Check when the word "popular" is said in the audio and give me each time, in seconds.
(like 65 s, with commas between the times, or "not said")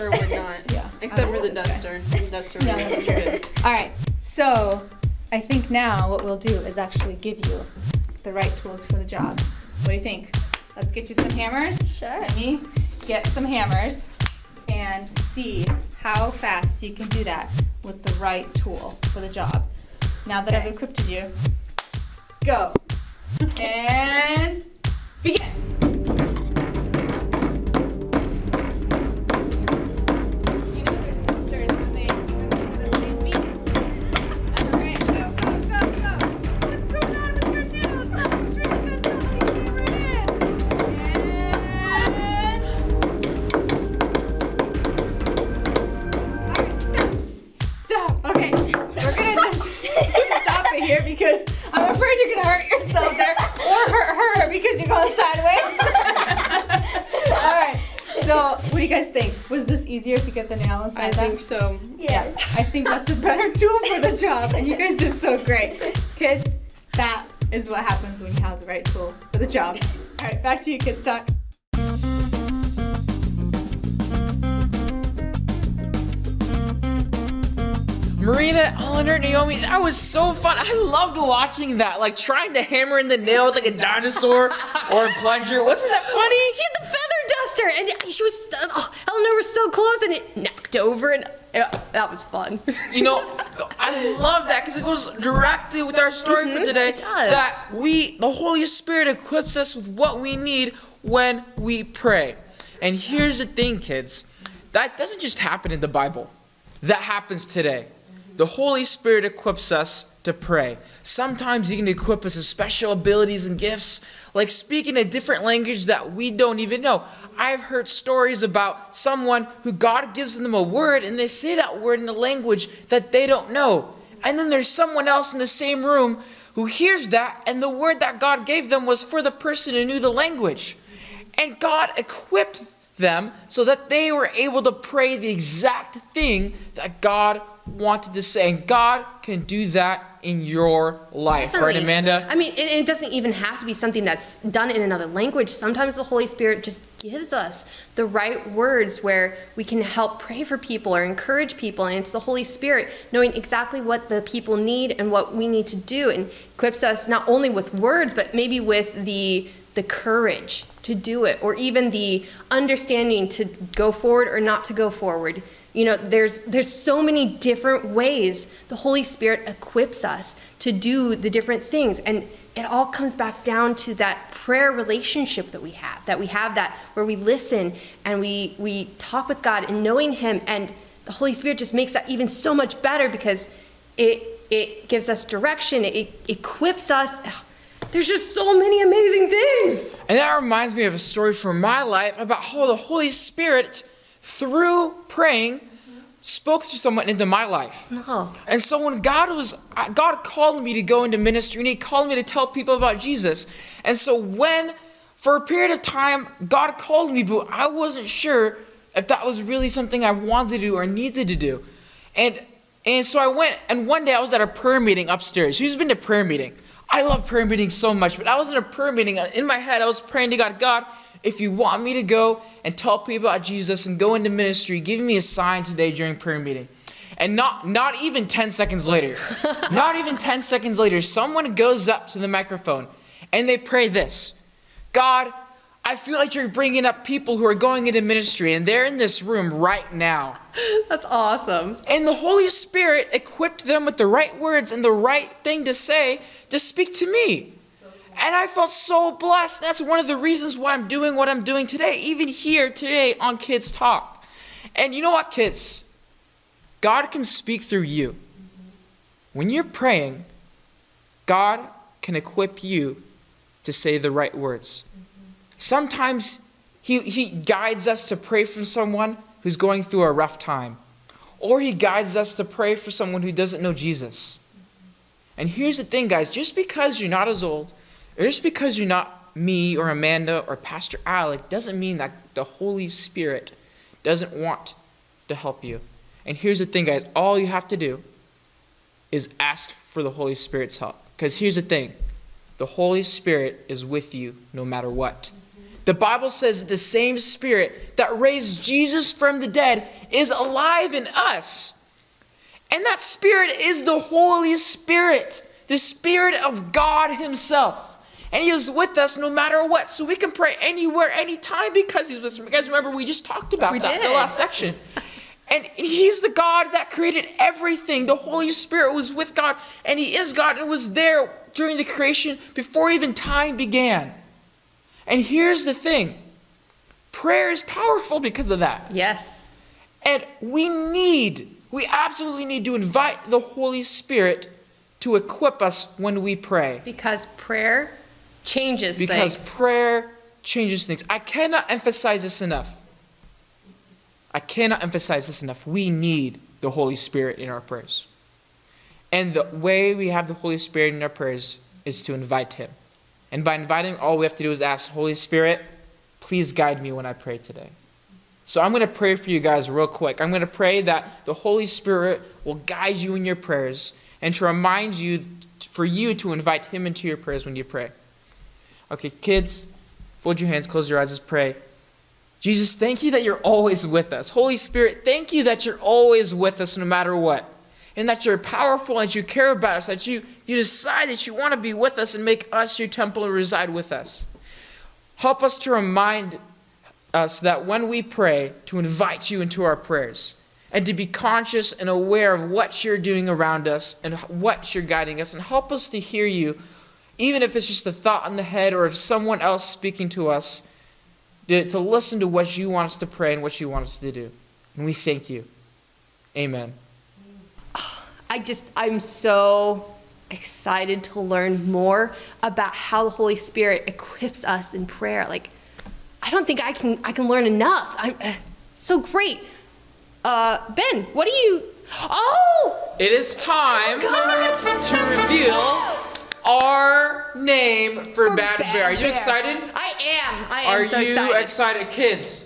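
not said.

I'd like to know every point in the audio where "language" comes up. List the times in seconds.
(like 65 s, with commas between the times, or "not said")
115 s, 122 s, 130 s, 145 s.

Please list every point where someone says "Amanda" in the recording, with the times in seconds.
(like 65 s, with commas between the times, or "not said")
141 s, 279 s.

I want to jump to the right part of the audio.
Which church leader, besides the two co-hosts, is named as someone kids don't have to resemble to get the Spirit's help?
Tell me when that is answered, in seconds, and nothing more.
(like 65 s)
280 s.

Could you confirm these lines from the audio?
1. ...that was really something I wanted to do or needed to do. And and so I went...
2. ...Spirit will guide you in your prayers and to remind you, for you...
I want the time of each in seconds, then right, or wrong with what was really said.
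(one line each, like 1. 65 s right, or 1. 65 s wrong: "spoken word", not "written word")
1. 209 s right
2. 361 s right.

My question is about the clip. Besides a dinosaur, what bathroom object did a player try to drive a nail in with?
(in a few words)
plunger.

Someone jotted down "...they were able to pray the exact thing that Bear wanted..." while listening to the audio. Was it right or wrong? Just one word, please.
wrong.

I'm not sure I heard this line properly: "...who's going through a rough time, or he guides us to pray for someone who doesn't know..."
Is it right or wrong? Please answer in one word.
right.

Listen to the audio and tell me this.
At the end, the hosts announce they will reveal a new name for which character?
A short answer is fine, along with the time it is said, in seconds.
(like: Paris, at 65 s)
Bad, Bad Bear, at 428 s.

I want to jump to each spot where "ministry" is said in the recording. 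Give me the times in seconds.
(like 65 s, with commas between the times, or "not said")
201 s, 224 s, 238 s.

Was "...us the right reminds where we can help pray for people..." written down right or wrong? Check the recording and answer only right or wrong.
wrong.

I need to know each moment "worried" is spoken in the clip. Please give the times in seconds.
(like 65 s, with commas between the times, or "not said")
not said.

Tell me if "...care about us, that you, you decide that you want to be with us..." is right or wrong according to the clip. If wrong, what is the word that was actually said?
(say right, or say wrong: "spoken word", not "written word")
right.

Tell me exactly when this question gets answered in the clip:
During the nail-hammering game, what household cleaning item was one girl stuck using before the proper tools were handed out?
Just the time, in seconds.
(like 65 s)
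86 s.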